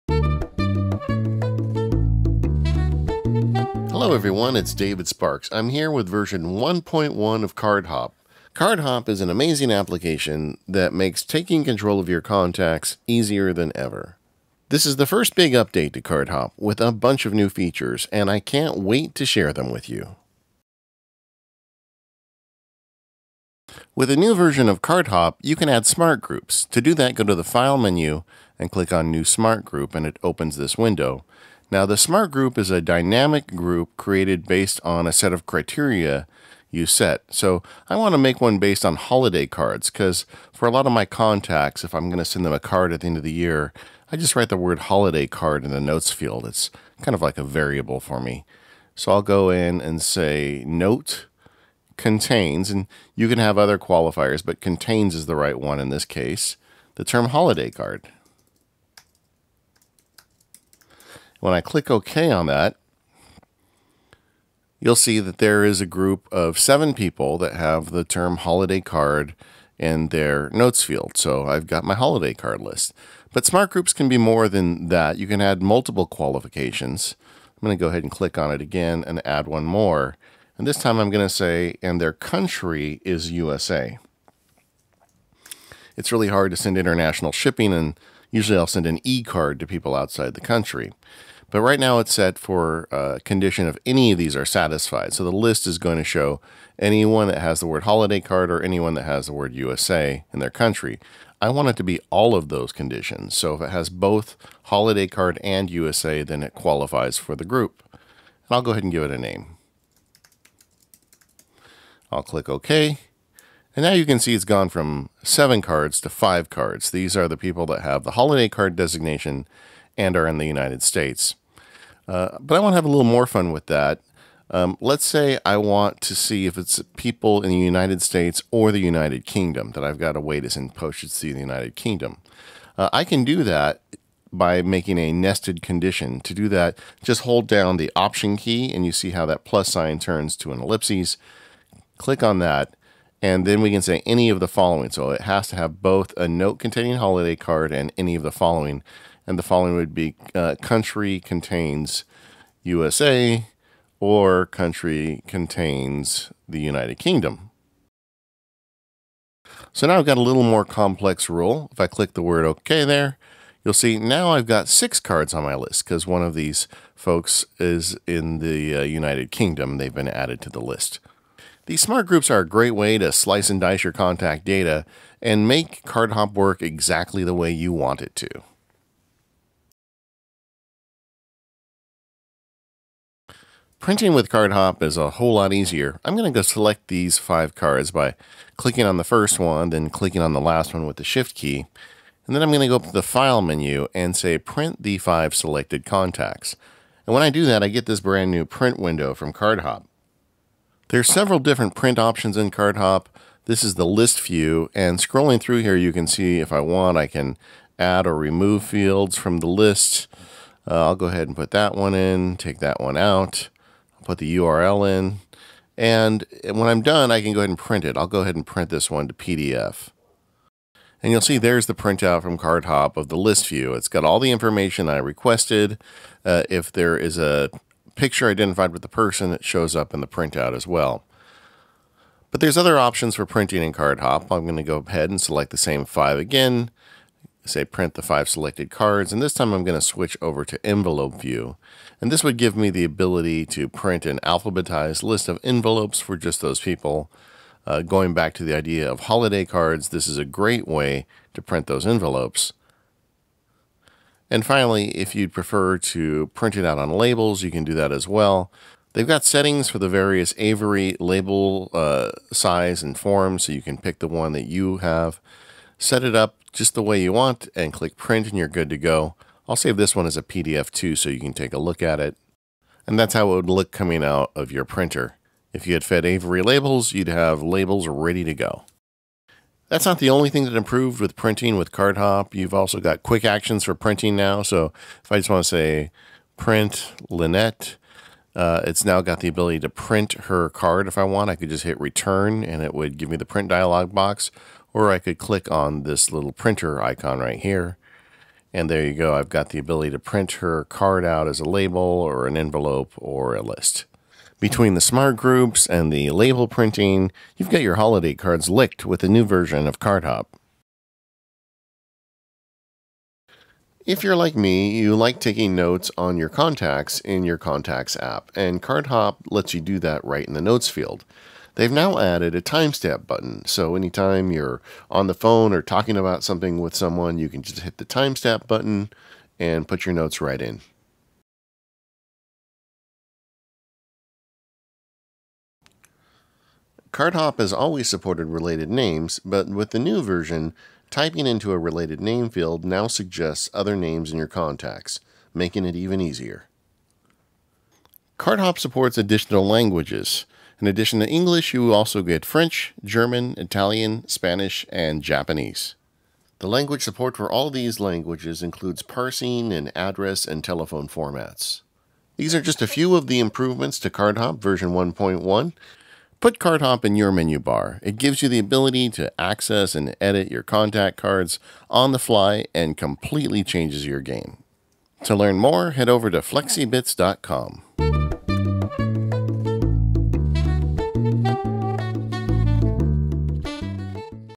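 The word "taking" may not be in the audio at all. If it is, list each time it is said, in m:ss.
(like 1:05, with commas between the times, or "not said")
0:11, 5:15.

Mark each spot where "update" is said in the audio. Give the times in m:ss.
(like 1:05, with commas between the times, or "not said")
0:15.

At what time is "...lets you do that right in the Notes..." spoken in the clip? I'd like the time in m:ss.
5:19.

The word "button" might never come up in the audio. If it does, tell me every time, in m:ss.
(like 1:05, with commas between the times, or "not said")
5:23, 5:28.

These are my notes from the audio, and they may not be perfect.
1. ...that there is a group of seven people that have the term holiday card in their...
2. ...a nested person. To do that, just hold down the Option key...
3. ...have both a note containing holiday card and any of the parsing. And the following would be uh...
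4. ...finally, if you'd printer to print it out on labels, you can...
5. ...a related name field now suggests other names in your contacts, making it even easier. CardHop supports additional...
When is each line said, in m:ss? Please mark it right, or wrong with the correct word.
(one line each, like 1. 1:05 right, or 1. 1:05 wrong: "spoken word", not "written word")
1. 1:05 right
2. 2:14 wrong: "condition", not "person"
3. 2:25 wrong: "following", not "parsing"
4. 4:14 wrong: "prefer", not "printer"
5. 5:41 right.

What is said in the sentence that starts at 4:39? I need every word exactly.
That's not the only thing that improved with printing with Card Hop.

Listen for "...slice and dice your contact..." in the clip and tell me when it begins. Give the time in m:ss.
2:53.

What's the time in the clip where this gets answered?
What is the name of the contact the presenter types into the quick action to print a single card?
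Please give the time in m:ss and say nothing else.
4:47.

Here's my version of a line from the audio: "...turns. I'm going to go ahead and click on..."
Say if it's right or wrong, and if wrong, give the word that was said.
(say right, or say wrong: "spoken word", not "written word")
wrong: "qualifications", not "turns".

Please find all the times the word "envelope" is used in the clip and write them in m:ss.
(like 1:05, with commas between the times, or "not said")
4:00, 4:05, 4:11, 5:02.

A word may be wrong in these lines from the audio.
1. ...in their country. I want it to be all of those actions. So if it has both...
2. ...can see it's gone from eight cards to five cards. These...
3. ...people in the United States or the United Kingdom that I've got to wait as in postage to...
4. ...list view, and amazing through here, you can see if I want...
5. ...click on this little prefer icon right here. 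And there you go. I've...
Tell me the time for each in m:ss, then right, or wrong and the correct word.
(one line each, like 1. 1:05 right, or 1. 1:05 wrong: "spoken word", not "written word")
1. 1:40 wrong: "conditions", not "actions"
2. 1:54 wrong: "seven", not "eight"
3. 2:06 right
4. 3:23 wrong: "scrolling", not "amazing"
5. 4:55 wrong: "printer", not "prefer".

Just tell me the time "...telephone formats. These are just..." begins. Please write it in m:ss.
6:00.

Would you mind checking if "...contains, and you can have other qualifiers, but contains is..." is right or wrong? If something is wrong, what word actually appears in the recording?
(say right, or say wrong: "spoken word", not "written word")
right.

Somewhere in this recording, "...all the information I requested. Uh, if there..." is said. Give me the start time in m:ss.
3:44.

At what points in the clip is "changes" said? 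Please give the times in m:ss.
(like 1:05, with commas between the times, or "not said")
6:13.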